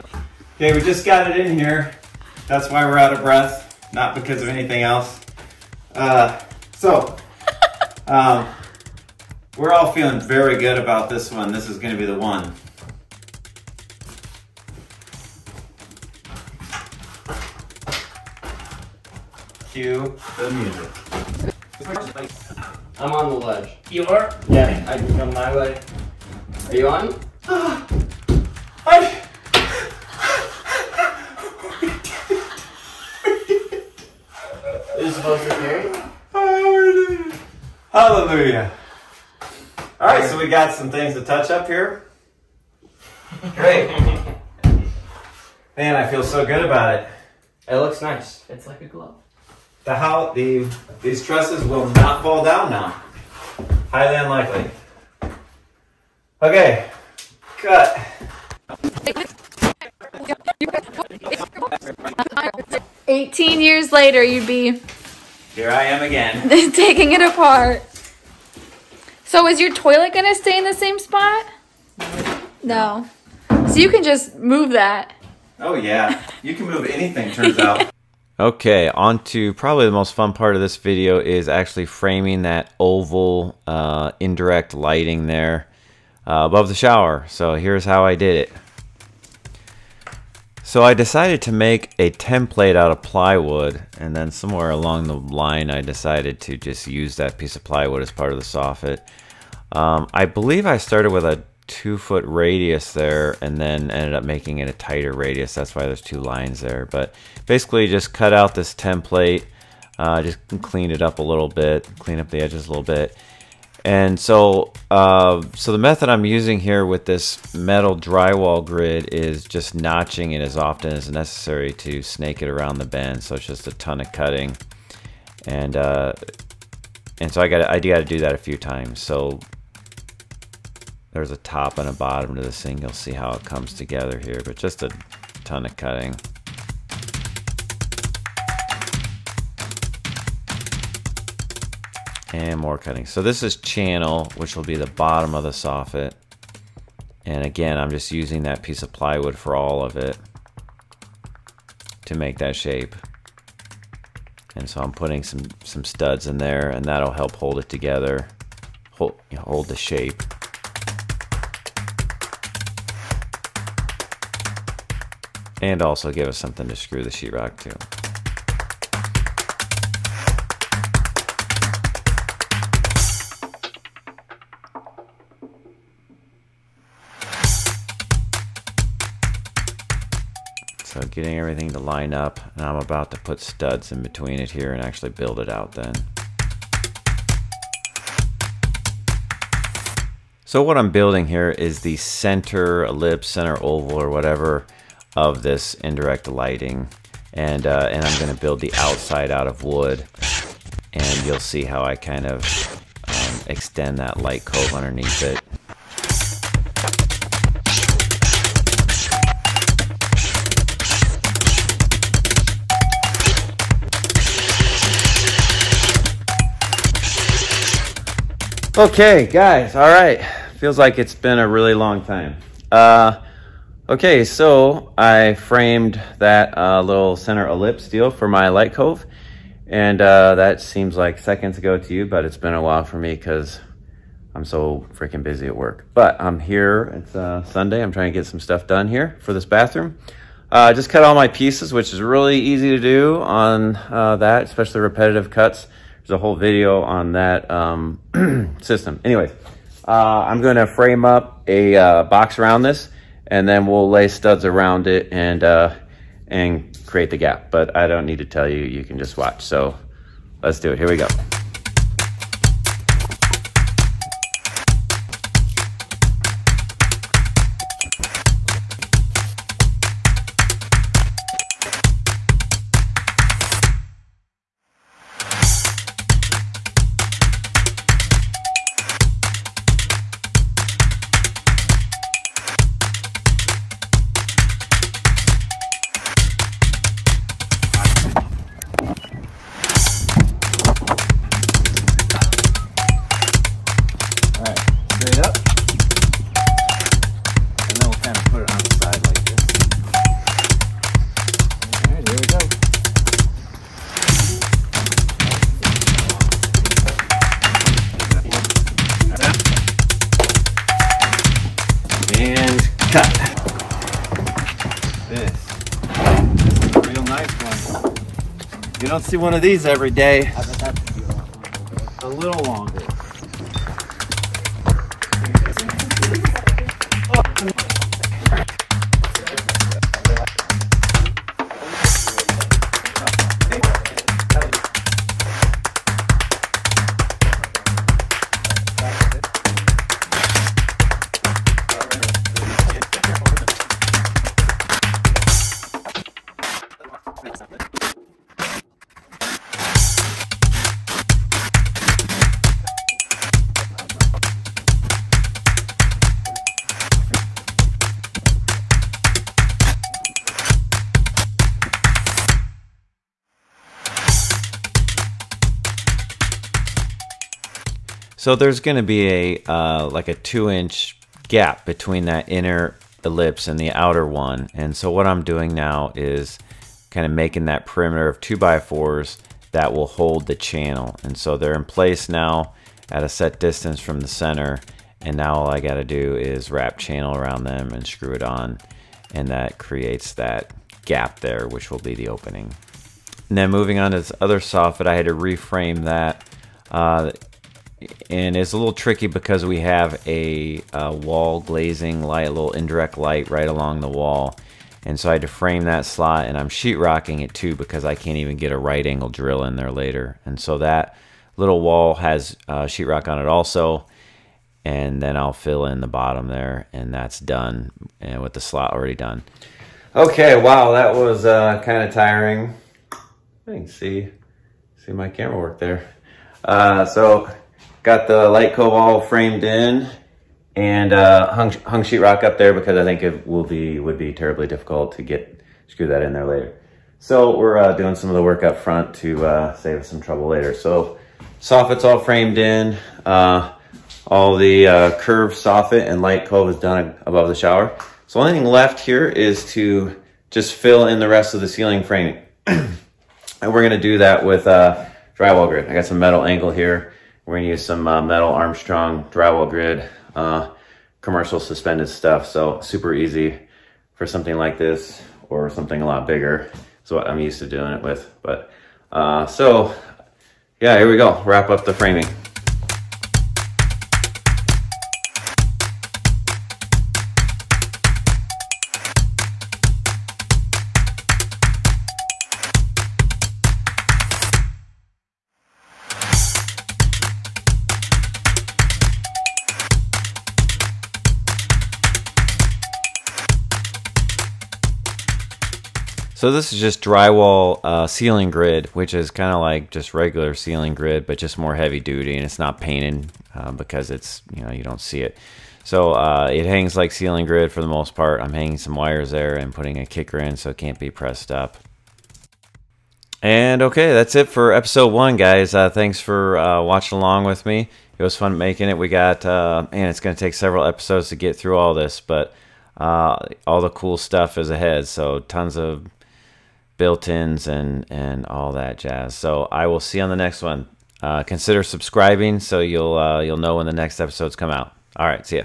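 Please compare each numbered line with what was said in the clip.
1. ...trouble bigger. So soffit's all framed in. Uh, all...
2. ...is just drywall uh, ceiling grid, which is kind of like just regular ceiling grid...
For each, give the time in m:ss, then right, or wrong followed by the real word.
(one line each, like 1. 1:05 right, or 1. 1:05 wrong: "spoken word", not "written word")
1. 7:20 wrong: "later", not "bigger"
2. 8:16 right.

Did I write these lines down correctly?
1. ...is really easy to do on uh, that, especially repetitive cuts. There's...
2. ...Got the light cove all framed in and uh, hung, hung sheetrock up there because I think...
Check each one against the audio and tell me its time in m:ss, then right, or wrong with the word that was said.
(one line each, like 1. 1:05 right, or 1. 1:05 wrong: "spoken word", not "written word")
1. 4:01 right
2. 7:07 right.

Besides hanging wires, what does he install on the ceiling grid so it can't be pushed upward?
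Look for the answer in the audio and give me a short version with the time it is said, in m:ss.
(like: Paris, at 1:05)
a kicker, at 8:29.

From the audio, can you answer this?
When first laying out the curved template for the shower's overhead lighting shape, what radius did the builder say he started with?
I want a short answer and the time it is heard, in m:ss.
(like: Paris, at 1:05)
2 foot, at 1:41.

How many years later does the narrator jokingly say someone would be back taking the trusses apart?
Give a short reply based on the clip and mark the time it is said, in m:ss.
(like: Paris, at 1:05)
18, at 1:03.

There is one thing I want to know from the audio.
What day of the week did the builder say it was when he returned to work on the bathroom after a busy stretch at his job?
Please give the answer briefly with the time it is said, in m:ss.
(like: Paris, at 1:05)
Sunday, at 3:57.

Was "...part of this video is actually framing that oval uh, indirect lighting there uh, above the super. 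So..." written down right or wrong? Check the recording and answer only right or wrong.
wrong.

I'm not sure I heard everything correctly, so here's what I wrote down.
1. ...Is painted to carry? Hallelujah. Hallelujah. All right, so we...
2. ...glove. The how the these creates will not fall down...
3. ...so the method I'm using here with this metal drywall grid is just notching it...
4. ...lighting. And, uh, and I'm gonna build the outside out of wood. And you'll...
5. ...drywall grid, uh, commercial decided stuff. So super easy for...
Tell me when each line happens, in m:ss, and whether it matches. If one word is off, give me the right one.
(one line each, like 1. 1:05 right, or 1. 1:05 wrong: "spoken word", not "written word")
1. 0:34 wrong: "supposed", not "painted"
2. 0:48 wrong: "trusses", not "creates"
3. 1:55 right
4. 3:16 right
5. 7:39 wrong: "suspended", not "decided".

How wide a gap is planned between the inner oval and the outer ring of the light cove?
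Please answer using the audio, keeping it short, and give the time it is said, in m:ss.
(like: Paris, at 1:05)
2 inch, at 6:10.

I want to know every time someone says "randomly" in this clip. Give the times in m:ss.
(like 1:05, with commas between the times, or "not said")
not said.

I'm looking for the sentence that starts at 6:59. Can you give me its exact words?
Okay, wow, that was uh, kind of tiring.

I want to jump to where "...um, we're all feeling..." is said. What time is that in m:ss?
0:08.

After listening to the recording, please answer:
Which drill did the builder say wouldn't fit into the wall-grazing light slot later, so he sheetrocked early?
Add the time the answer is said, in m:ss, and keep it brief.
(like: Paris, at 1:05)
right angle drill, at 6:48.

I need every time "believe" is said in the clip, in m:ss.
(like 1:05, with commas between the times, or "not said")
1:40.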